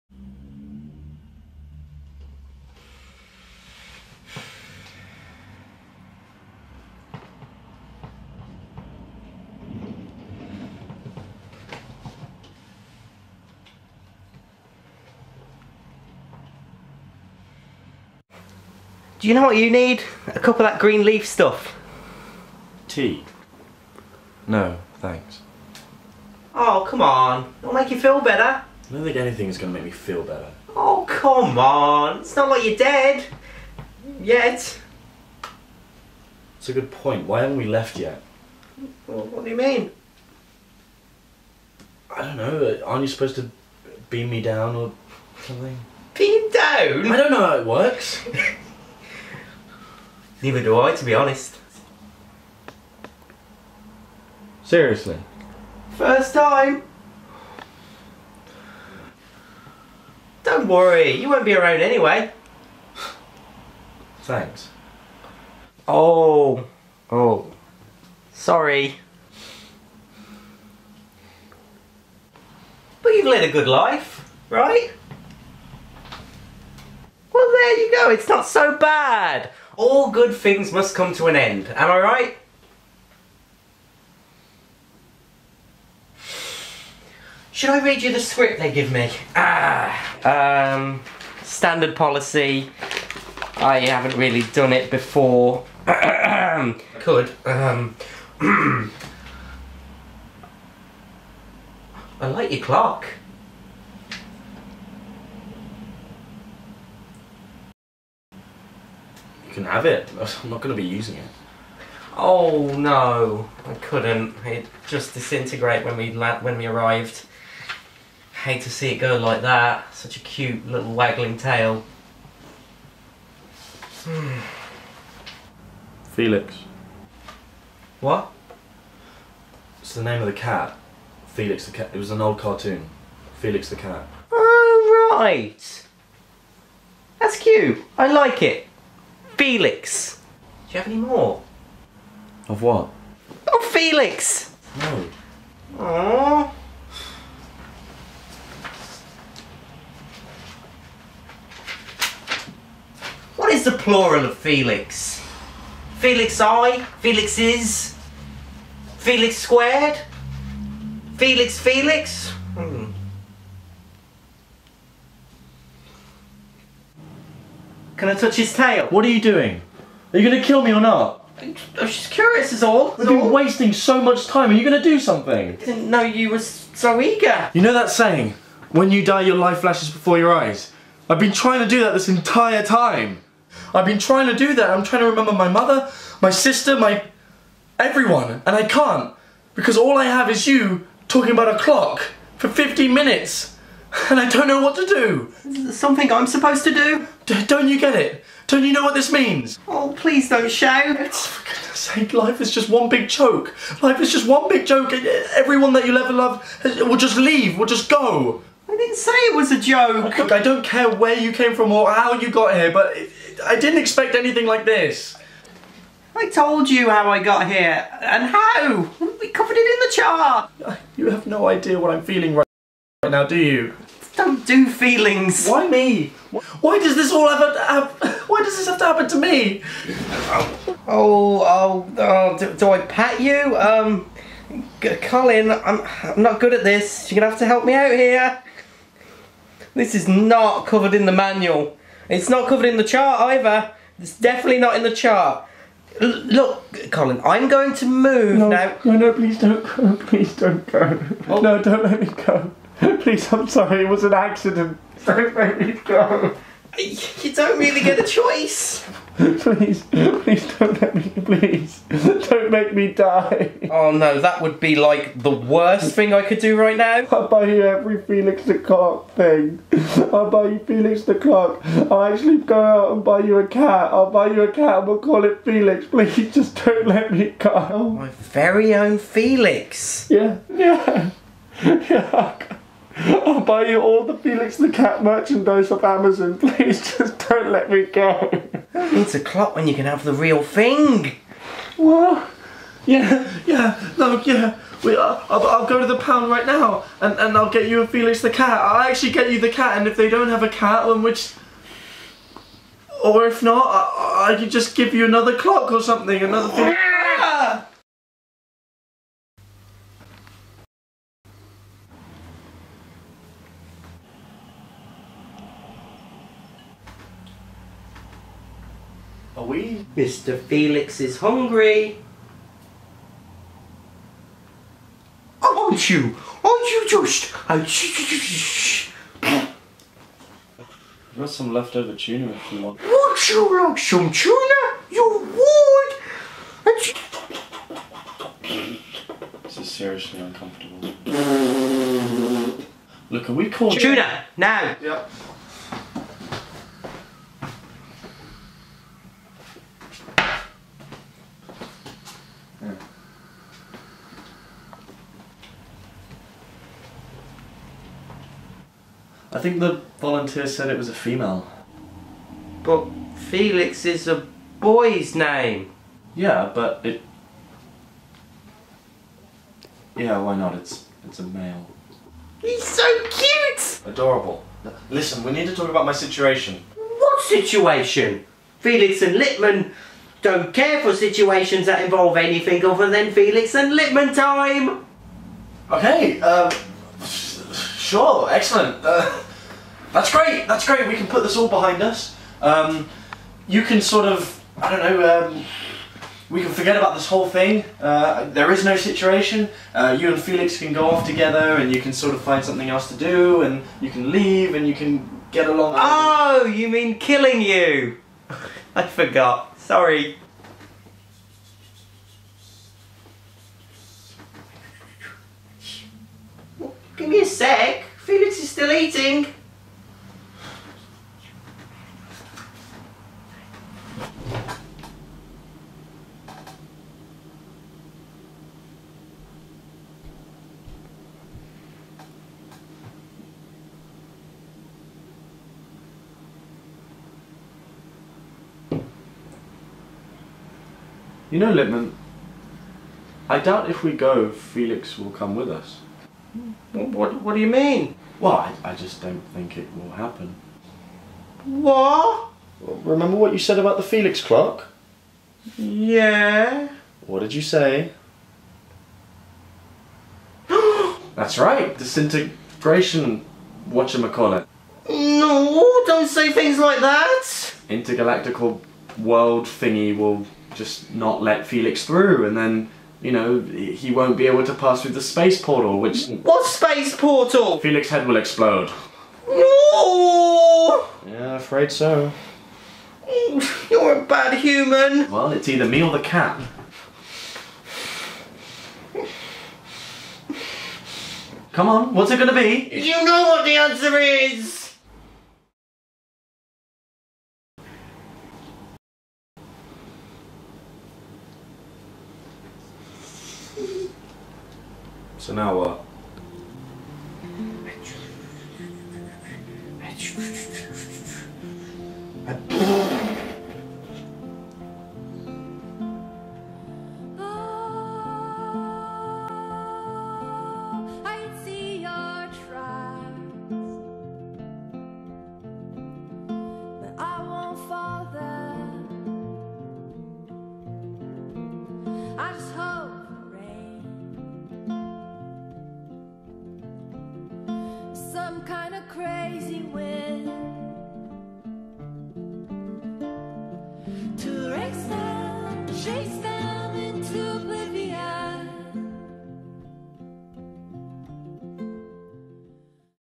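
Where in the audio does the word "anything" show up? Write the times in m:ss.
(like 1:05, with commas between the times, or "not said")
0:29, 3:34, 6:22.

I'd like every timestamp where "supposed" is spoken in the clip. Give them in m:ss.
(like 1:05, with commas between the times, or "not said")
0:43, 3:16.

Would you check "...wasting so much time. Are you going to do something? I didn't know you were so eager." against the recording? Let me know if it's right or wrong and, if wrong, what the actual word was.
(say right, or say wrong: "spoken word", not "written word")
right.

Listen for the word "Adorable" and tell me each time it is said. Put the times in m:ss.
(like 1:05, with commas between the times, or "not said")
6:13.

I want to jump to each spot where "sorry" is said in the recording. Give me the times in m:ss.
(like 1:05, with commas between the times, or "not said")
1:08, 4:13, 6:49.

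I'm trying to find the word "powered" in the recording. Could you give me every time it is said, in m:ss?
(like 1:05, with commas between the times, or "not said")
not said.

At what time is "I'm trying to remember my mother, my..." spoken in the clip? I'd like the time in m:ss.
3:04.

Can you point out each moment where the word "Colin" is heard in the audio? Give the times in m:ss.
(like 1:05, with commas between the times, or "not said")
3:55, 4:06.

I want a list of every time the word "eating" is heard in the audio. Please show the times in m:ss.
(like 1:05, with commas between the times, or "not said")
6:58.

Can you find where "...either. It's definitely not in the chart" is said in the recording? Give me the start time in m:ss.
4:03.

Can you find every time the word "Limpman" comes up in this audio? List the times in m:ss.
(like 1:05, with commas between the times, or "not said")
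6:19, 6:23, 7:21.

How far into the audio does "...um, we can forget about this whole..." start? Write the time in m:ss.
6:35.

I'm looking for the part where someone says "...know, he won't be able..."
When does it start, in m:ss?
7:53.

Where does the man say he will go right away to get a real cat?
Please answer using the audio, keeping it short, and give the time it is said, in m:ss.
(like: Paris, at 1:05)
The pound, at 4:55.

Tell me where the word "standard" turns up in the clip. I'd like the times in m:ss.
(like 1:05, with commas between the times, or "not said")
1:31.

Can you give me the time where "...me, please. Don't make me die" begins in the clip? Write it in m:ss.
4:20.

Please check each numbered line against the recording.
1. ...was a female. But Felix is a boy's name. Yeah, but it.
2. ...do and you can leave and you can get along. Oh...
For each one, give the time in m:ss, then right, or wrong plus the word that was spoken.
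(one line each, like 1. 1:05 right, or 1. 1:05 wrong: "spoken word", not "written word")
1. 6:00 right
2. 6:42 right.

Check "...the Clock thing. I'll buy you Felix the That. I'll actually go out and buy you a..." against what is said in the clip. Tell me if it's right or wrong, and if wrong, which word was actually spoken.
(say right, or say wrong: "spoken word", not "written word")
wrong: "Clock", not "That".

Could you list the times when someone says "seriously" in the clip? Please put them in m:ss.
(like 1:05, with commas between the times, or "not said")
0:54, 5:39.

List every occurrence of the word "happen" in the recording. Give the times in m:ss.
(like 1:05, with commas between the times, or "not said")
3:48, 7:29.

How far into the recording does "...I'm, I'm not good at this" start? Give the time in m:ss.
3:55.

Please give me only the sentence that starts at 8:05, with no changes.
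Well, it's either me or the cat.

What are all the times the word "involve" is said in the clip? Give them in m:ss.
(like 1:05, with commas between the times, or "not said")
6:21.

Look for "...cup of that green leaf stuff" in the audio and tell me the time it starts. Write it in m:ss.
0:20.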